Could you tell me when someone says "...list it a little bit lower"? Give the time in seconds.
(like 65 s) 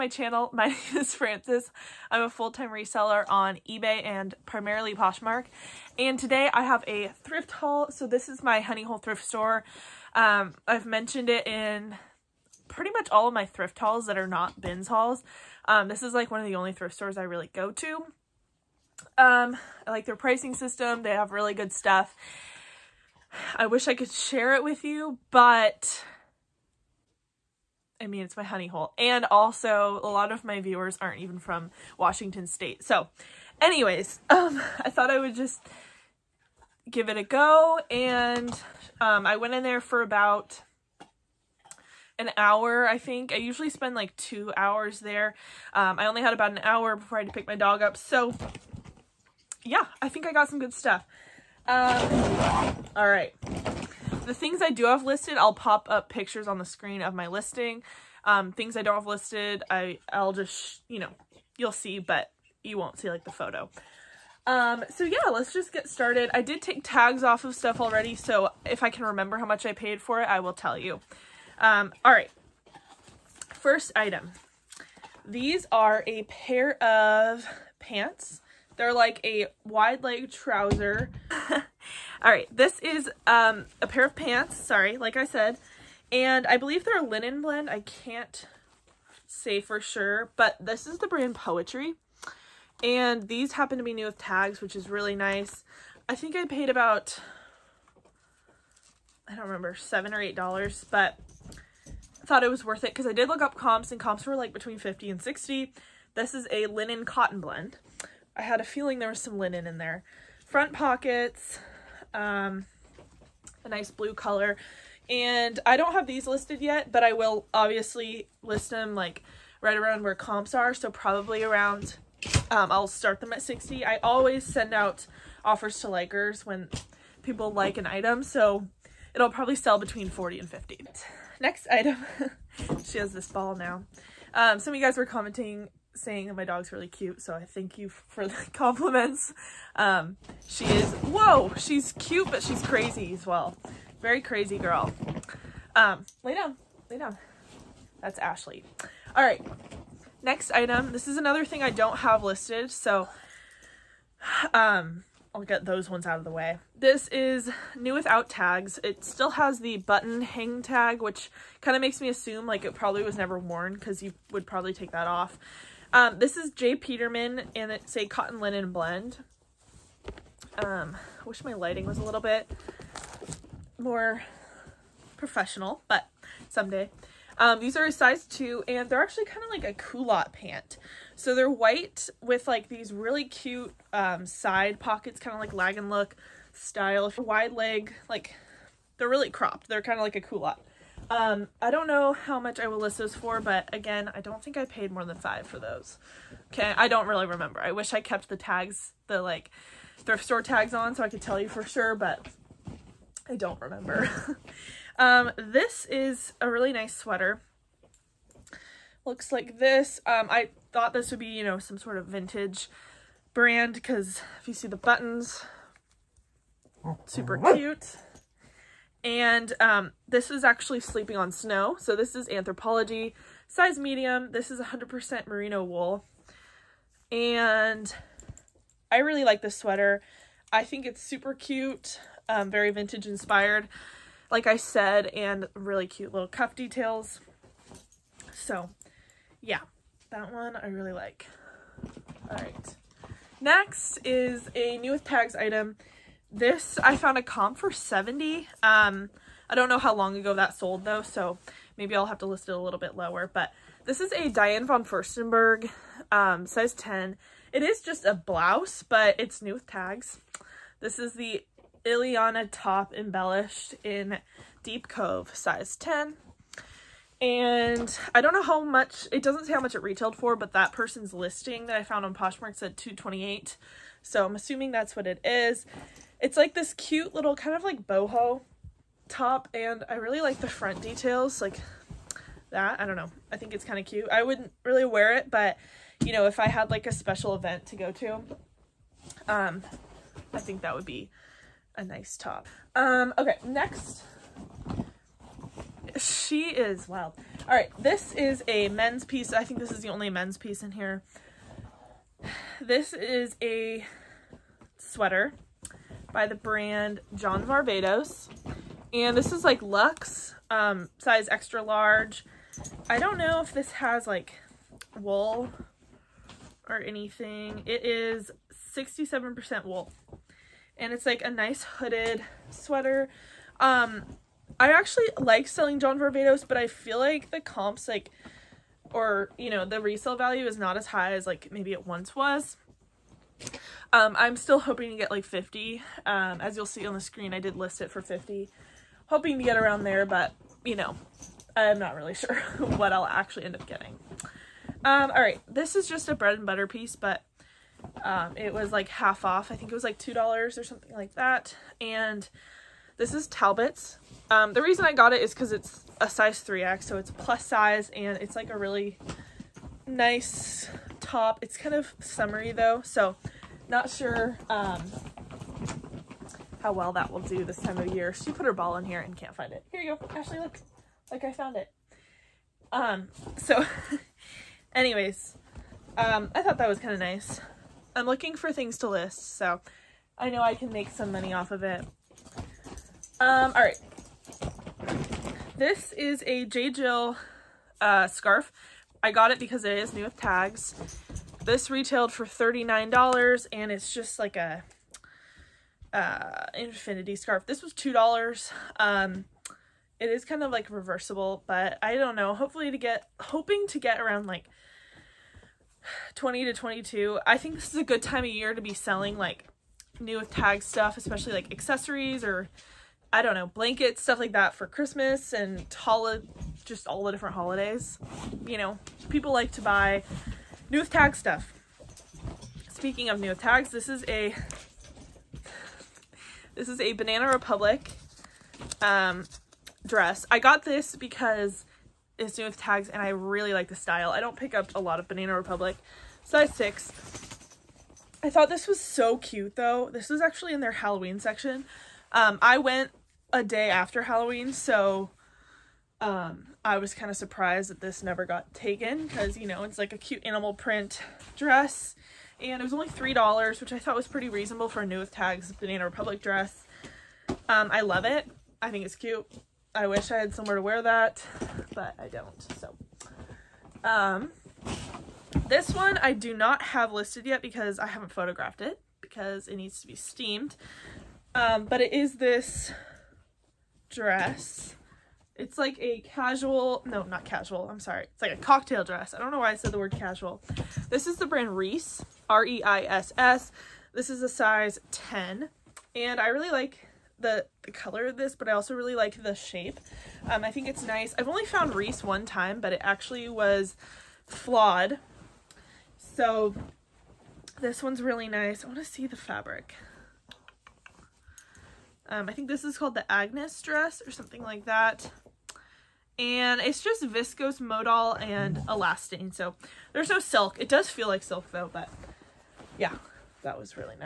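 252 s.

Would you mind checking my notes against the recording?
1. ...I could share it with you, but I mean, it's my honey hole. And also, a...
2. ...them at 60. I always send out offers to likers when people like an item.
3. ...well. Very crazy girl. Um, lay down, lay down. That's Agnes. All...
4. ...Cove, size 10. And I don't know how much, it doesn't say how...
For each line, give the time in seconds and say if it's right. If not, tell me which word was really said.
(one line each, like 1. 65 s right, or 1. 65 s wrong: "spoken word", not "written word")
1. 23 s right
2. 123 s right
3. 143 s wrong: "Ashley", not "Agnes"
4. 264 s right.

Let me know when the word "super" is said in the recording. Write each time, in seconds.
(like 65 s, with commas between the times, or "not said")
217 s, 231 s.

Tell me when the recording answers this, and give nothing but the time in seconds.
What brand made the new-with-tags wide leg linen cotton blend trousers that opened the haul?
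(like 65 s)
91 s.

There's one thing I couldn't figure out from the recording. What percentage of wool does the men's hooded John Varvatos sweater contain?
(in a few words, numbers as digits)
67%.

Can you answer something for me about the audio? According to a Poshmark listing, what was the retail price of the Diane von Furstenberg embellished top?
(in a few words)
228.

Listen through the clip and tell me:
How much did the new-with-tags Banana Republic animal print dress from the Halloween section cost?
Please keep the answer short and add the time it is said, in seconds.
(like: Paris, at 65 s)
$3, at 452 s.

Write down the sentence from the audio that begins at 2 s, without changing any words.
I'm a full-time reseller on eBay and primarily Poshmark.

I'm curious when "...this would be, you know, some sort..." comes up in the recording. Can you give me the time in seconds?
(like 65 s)
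210 s.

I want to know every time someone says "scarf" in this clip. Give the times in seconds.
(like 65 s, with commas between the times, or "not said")
388 s, 397 s.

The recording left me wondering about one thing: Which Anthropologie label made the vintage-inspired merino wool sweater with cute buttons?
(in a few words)
Sleeping on Snow.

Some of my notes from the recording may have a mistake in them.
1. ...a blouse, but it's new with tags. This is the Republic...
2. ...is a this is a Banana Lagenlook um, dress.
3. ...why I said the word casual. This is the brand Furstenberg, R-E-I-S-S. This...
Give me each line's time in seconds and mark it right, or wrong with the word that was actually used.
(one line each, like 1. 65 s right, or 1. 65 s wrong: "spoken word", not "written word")
1. 258 s wrong: "Iliana", not "Republic"
2. 423 s wrong: "Republic", not "Lagenlook"
3. 479 s wrong: "Reiss", not "Furstenberg".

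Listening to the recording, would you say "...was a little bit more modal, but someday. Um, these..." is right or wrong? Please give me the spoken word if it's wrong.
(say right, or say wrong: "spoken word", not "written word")
wrong: "professional", not "modal".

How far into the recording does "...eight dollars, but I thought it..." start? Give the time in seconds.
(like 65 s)
100 s.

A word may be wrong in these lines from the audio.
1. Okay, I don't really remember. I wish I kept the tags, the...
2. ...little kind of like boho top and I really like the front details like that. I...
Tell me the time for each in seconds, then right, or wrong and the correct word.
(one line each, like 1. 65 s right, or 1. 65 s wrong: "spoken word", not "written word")
1. 196 s right
2. 277 s right.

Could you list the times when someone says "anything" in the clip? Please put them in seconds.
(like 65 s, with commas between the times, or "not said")
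316 s.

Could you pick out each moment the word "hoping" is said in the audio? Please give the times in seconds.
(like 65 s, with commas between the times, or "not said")
334 s, 339 s, 403 s.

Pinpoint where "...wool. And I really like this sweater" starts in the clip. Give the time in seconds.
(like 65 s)
225 s.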